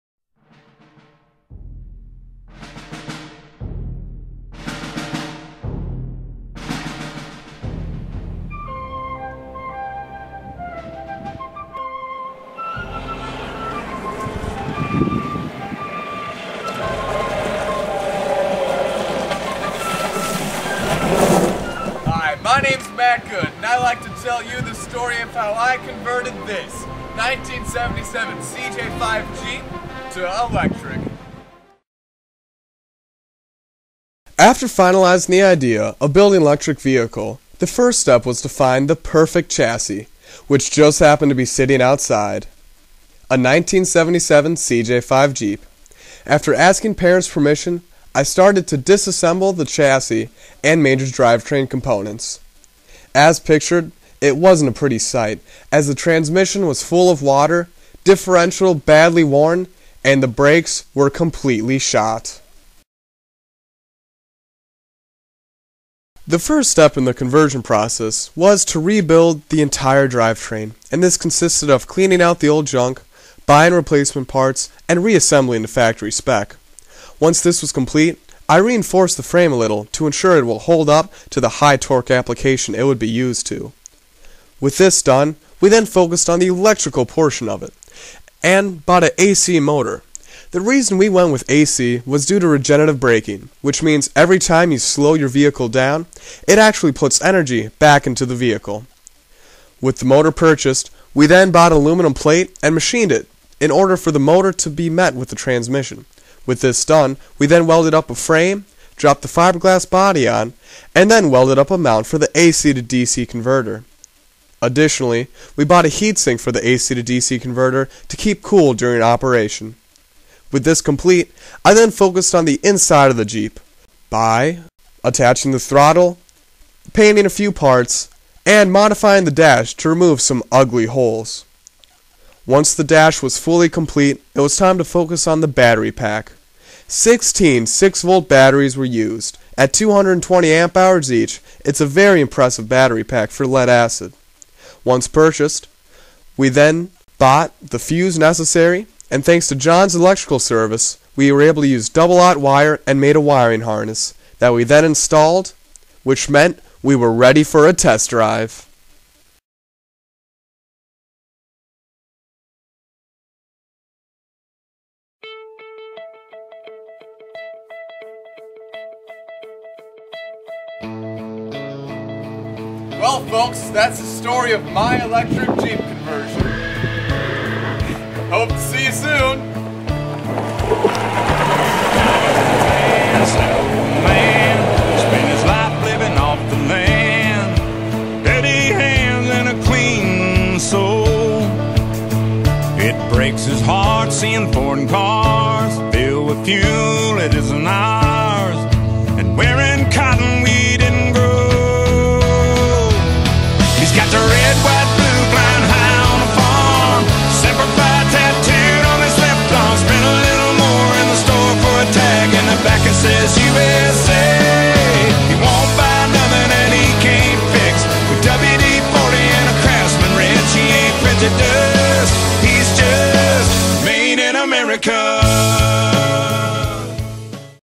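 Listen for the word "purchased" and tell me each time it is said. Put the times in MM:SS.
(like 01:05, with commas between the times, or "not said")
01:40, 02:25.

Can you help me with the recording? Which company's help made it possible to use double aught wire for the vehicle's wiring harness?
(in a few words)
John's electrical service.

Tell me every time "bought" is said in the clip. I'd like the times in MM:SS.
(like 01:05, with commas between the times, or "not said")
01:28, 01:41, 01:55, 02:27.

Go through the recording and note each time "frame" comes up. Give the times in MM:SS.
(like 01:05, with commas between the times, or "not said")
01:19, 01:48.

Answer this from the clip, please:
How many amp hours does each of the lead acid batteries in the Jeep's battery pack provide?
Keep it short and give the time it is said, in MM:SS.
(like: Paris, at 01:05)
220, at 02:19.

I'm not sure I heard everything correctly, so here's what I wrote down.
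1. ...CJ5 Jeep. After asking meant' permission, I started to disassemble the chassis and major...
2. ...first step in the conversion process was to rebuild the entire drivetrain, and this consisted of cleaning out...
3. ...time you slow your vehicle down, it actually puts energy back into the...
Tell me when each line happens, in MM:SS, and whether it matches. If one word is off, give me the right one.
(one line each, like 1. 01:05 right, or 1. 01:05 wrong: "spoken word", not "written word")
1. 00:44 wrong: "parents", not "meant"
2. 01:06 right
3. 01:34 right.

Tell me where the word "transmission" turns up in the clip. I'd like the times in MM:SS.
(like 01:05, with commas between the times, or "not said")
00:55, 01:45.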